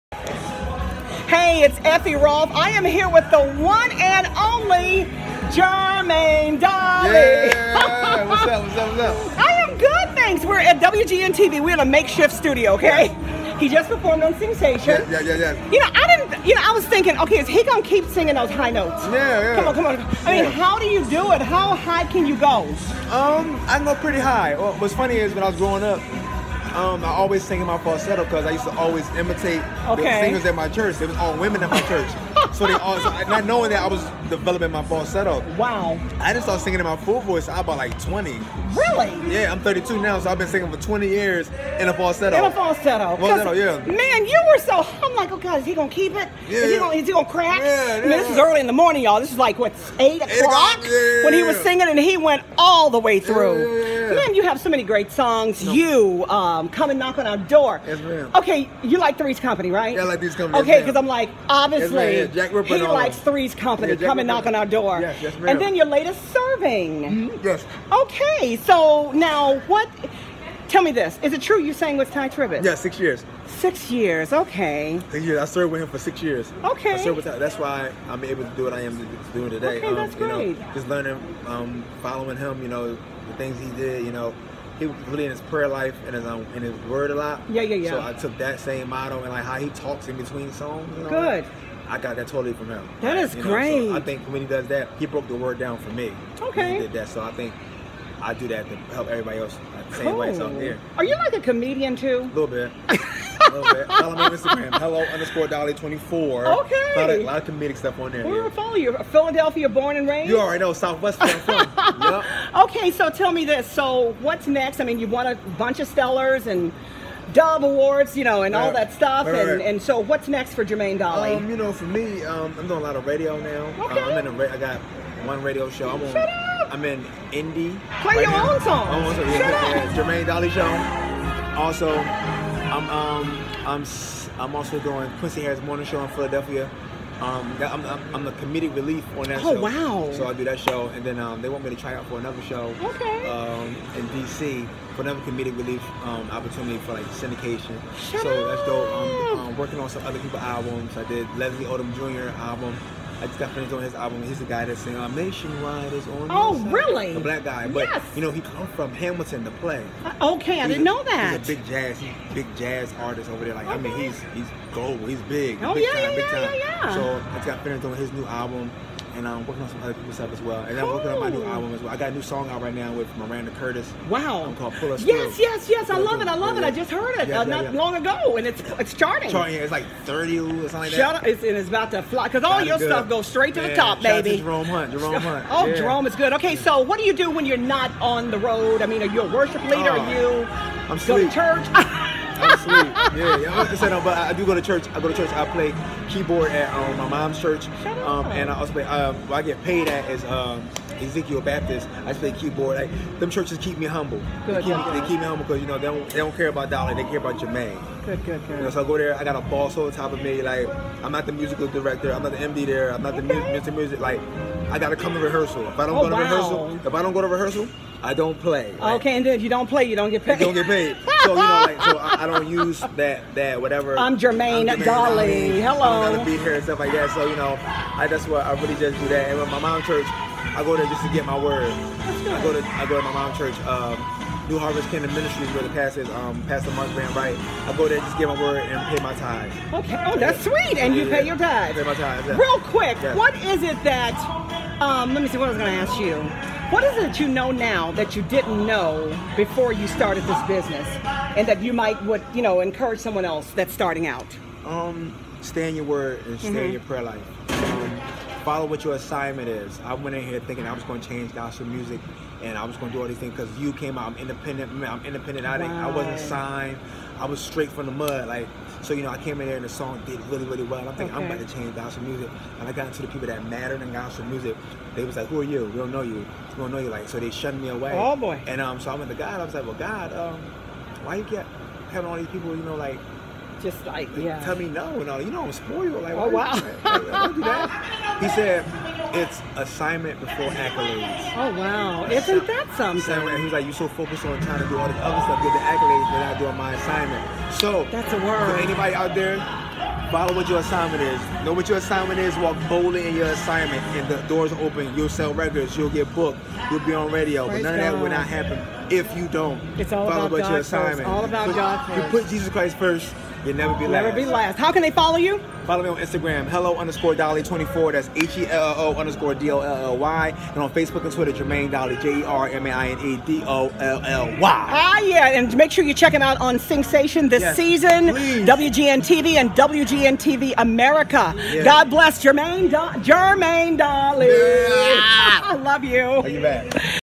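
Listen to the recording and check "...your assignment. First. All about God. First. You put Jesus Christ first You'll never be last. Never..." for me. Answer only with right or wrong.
right.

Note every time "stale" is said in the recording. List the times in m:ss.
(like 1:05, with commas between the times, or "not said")
not said.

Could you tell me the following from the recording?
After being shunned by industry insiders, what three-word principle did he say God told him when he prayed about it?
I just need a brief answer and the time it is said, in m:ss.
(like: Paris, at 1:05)
Assignment before accolades, at 4:49.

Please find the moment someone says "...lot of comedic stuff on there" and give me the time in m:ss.
1:47.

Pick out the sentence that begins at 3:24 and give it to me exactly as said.
Good, they, keep me, they keep me humble because you know they don't, they don't care about dollar.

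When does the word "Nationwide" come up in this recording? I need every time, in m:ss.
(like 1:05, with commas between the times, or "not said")
2:35.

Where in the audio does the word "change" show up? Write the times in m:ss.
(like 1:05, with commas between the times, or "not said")
4:21, 4:31.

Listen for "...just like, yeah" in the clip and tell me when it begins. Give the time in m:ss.
4:43.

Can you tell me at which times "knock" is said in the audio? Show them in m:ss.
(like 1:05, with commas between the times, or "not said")
0:56, 1:04.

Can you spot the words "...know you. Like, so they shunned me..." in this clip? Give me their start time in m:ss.
4:36.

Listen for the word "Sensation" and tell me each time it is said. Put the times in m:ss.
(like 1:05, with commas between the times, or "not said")
0:14, 5:26.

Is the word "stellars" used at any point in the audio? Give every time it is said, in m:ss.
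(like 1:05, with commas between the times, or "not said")
1:55.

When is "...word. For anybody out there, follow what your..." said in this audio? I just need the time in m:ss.
4:58.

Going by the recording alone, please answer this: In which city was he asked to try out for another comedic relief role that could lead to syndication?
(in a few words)
DC.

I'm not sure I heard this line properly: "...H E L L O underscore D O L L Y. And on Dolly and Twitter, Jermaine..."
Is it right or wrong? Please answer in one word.
wrong.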